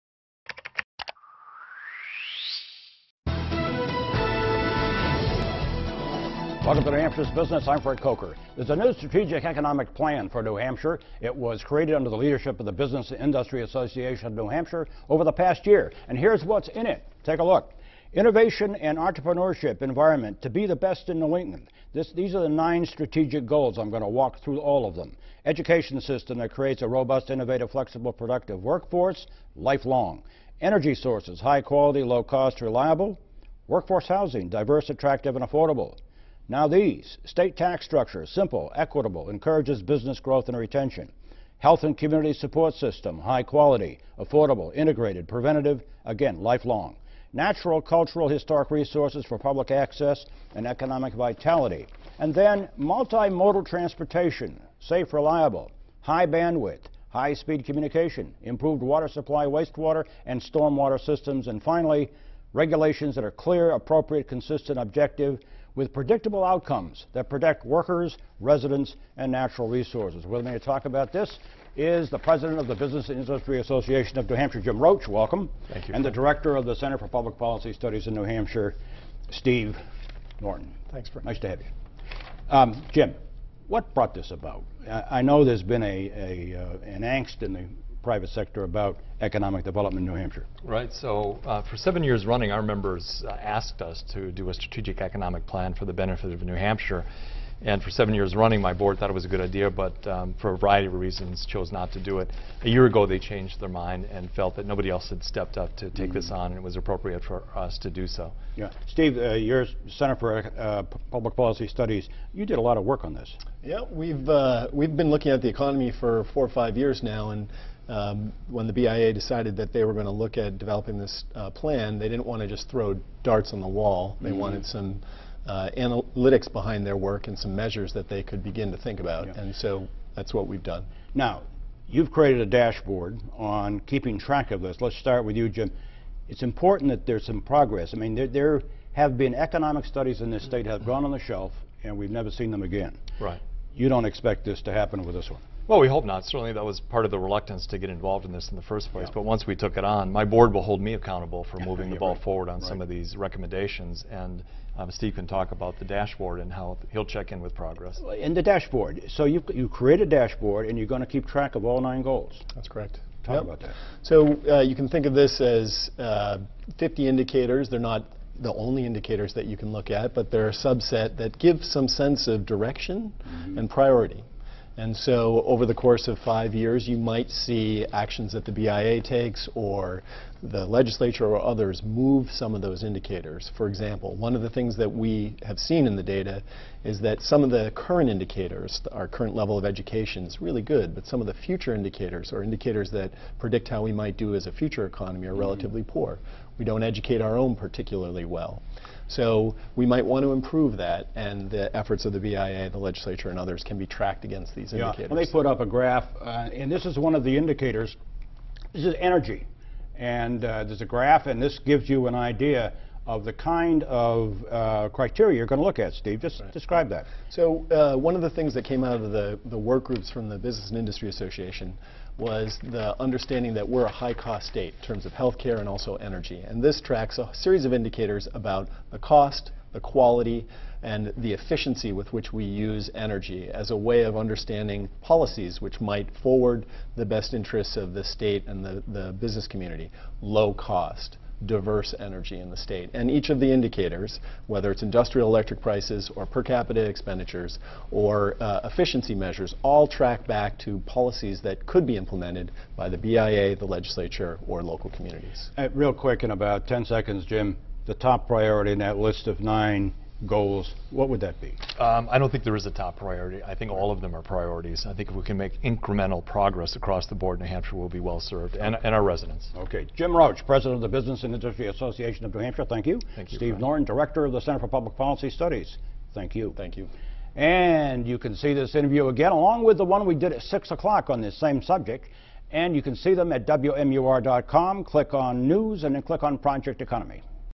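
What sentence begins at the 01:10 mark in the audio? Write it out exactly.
With me to talk about this is the president of the Business and Industry Association of New Hampshire, Jim Roche.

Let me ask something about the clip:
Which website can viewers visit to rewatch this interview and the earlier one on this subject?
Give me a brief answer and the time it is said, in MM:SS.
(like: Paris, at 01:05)
WMUR.com, at 04:43.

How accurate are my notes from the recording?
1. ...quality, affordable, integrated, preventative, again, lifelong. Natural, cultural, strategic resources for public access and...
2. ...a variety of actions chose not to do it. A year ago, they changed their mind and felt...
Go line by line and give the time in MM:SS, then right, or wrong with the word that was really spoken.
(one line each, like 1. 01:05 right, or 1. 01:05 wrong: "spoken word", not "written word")
1. 00:43 wrong: "historic", not "strategic"
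2. 01:40 wrong: "reasons", not "actions".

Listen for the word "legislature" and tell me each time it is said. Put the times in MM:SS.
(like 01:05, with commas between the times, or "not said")
03:00, 03:22, 04:13.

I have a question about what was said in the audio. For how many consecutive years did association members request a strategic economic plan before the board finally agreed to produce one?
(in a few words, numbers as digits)
7.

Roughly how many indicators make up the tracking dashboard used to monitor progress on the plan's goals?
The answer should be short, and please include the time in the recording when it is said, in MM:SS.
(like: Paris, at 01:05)
50, at 02:46.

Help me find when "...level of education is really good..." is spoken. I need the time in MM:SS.
03:09.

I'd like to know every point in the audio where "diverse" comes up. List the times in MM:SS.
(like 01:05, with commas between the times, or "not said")
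00:34, 04:01.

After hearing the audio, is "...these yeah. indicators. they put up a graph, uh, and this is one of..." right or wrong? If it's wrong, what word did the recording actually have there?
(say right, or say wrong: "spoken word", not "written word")
right.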